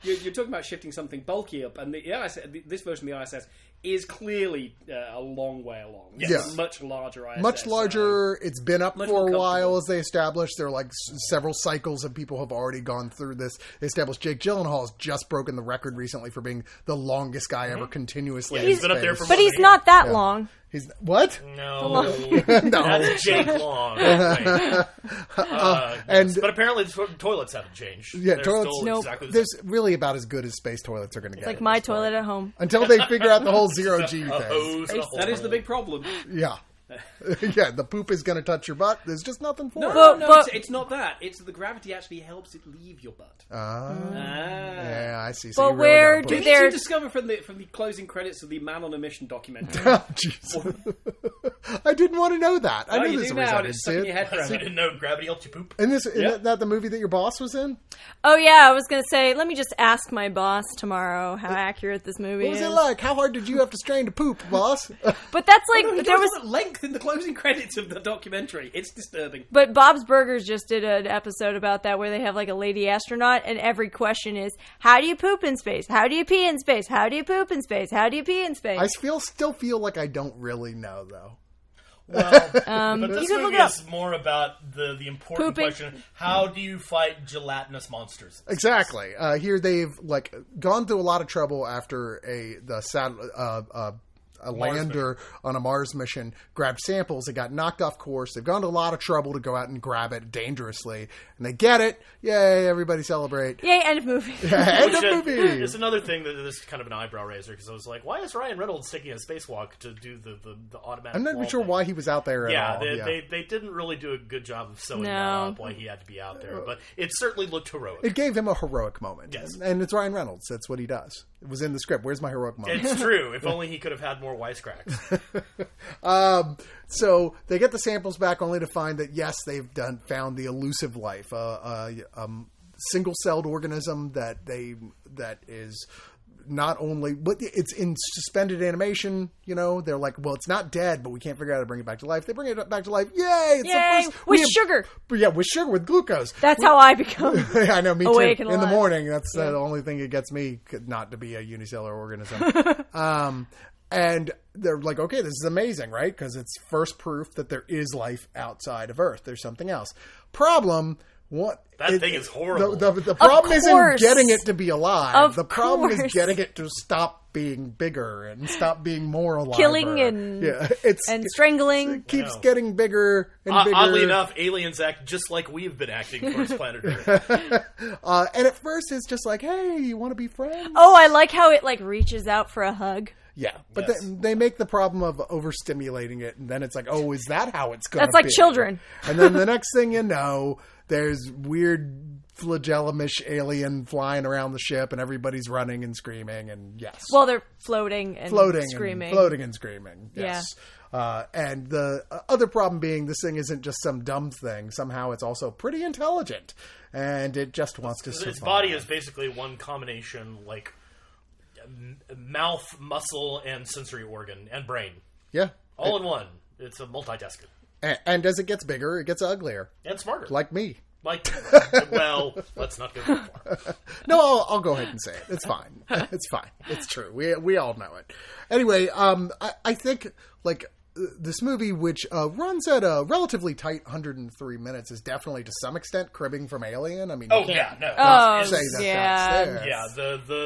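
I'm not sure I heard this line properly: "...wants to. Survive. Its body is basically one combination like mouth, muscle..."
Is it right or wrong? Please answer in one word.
right.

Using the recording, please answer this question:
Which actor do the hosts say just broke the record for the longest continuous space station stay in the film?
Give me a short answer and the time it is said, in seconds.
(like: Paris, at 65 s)
Jake Gyllenhaal, at 14 s.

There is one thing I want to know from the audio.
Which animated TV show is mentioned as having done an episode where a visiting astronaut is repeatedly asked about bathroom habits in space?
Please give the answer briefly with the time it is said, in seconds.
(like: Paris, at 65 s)
Bob's Burgers, at 69 s.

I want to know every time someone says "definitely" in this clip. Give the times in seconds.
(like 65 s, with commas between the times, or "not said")
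235 s.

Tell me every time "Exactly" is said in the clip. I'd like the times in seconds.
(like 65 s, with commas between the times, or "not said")
28 s, 88 s.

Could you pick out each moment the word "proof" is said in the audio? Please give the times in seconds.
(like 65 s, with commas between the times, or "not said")
156 s.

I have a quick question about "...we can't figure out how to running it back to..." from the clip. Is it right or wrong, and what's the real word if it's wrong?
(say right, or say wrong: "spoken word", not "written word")
wrong: "bring", not "running".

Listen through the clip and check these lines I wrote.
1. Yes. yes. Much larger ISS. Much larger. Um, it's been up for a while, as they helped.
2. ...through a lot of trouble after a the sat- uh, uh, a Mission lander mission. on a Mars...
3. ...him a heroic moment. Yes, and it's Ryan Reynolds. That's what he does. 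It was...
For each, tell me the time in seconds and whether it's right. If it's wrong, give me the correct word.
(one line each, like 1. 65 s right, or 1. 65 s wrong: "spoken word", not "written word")
1. 6 s wrong: "established", not "helped"
2. 90 s wrong: "Mars", not "Mission"
3. 118 s right.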